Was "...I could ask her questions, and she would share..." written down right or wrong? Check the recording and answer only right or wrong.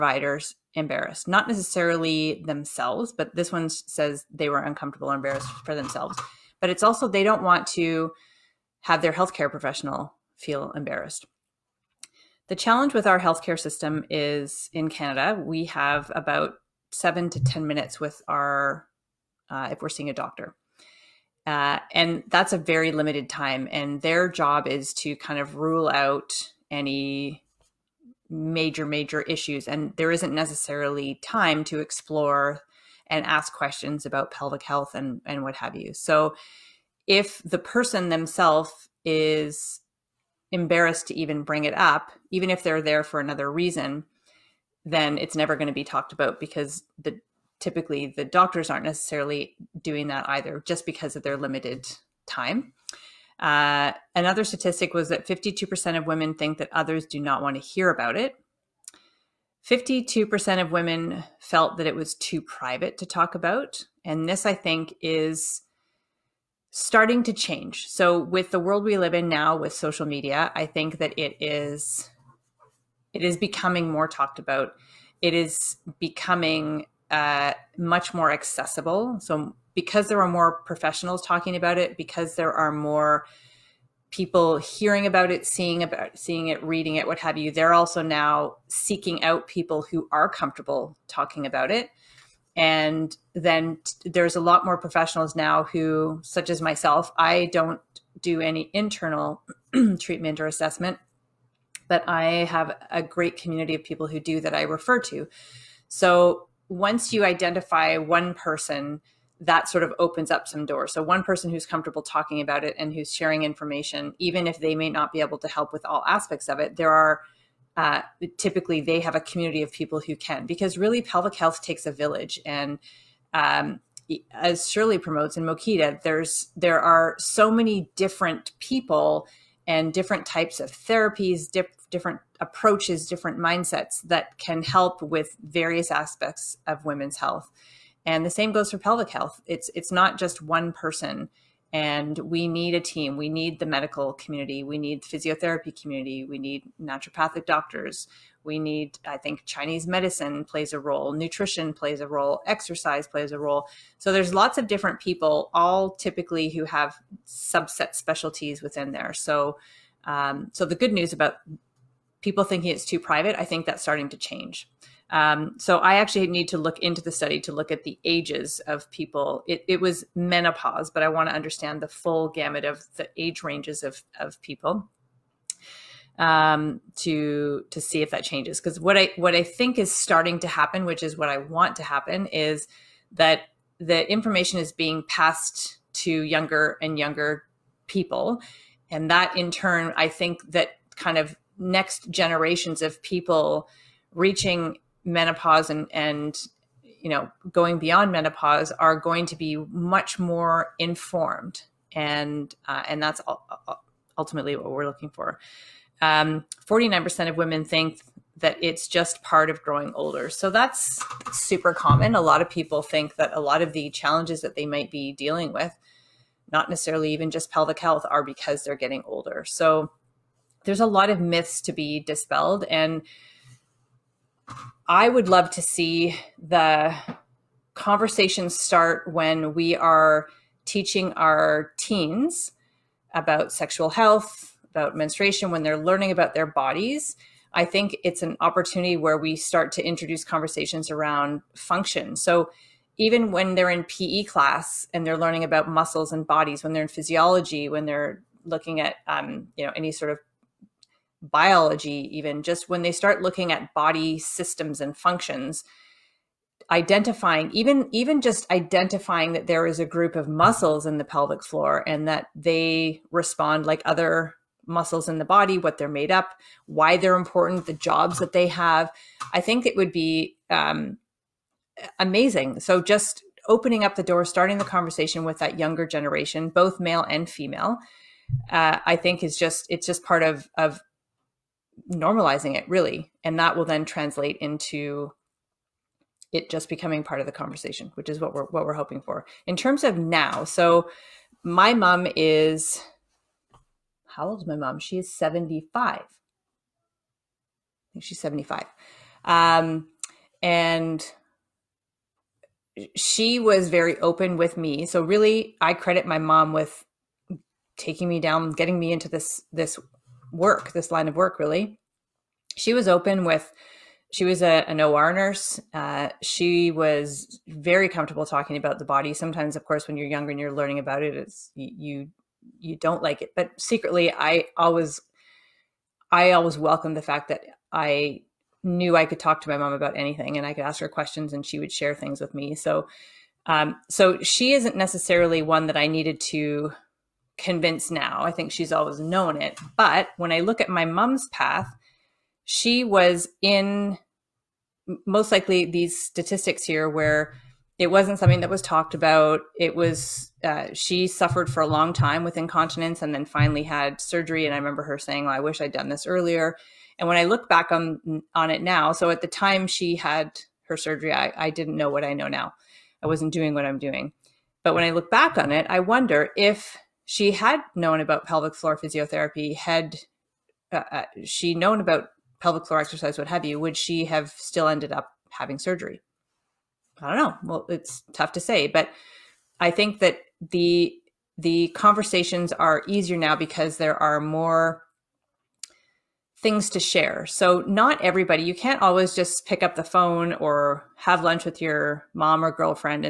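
right.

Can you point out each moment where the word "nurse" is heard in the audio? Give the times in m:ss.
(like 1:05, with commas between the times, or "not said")
5:15.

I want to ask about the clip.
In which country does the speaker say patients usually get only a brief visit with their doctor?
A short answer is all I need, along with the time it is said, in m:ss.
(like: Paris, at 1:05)
Canada, at 0:14.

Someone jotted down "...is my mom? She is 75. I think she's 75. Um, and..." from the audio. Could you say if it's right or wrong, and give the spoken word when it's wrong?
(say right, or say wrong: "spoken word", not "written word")
right.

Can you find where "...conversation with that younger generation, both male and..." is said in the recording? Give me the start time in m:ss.
4:34.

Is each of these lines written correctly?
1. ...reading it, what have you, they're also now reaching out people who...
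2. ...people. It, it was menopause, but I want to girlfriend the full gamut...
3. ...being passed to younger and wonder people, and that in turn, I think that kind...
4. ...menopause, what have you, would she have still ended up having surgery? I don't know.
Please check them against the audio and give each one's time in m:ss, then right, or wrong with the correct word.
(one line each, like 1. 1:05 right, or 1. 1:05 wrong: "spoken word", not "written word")
1. 1:26 wrong: "seeking", not "reaching"
2. 2:48 wrong: "understand", not "girlfriend"
3. 3:04 wrong: "younger", not "wonder"
4. 6:12 wrong: "exercise", not "menopause".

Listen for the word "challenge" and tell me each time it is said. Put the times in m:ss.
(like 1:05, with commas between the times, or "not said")
0:12, 3:33.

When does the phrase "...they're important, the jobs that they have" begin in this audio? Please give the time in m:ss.
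4:26.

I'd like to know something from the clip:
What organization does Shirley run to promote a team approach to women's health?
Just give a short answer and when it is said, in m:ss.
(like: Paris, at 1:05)
Mokita, at 2:05.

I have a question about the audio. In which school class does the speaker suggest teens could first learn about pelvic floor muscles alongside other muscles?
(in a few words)
PE class.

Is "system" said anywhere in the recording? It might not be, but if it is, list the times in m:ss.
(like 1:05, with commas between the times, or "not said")
0:13, 4:14.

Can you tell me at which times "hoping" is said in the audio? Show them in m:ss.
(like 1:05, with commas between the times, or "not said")
4:48.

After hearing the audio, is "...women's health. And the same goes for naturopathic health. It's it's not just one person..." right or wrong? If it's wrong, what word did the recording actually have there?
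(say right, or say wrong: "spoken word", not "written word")
wrong: "pelvic", not "naturopathic".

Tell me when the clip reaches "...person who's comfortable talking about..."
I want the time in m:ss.
1:51.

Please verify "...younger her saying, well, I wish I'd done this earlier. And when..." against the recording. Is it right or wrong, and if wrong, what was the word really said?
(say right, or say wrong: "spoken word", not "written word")
wrong: "remember", not "younger".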